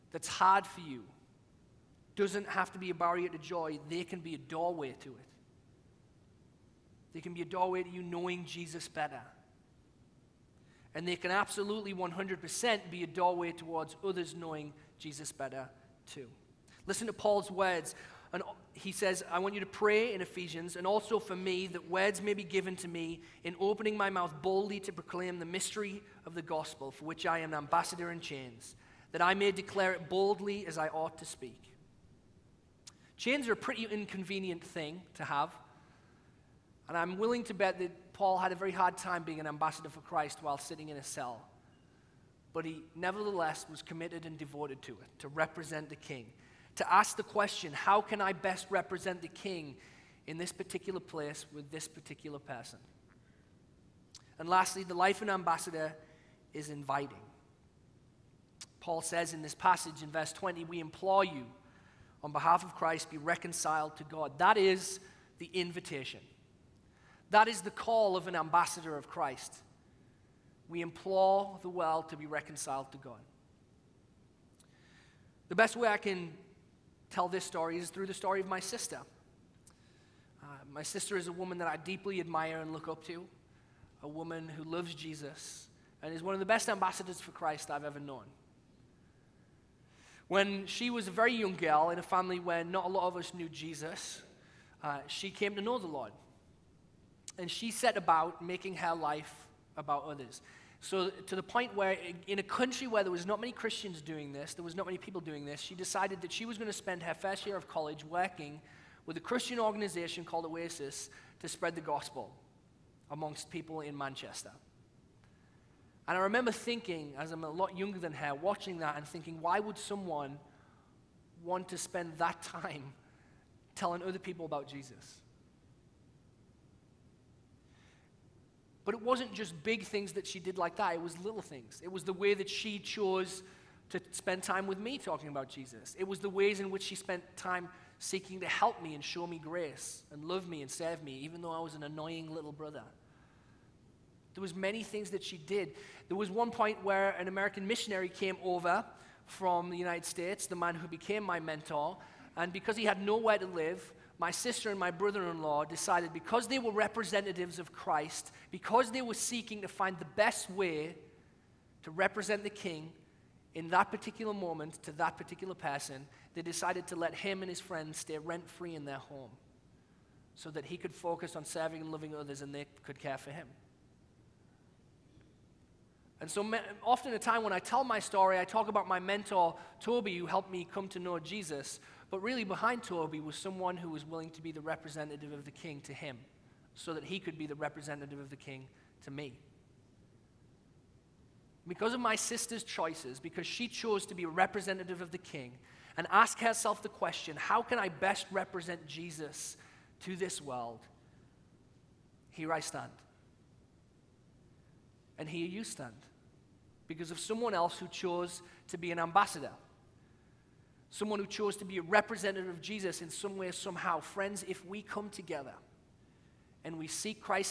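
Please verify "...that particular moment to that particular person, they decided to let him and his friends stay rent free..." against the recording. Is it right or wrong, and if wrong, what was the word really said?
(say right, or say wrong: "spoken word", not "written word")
right.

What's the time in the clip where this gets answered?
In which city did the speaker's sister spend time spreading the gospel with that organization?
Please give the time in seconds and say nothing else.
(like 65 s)
113 s.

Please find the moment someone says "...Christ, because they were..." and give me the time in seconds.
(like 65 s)
157 s.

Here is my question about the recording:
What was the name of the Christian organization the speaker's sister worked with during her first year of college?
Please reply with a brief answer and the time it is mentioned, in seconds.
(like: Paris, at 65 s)
Oasis, at 110 s.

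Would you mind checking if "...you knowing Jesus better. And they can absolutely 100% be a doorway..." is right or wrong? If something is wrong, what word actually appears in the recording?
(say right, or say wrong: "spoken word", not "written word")
right.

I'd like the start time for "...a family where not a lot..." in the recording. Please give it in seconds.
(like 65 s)
91 s.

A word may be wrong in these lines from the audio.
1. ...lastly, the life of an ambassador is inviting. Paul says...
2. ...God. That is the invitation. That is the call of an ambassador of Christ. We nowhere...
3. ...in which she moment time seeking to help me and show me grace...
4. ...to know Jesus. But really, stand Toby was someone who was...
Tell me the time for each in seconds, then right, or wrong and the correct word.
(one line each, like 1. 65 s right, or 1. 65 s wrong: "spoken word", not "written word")
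1. 54 s right
2. 64 s wrong: "implore", not "nowhere"
3. 136 s wrong: "spent", not "moment"
4. 180 s wrong: "behind", not "stand".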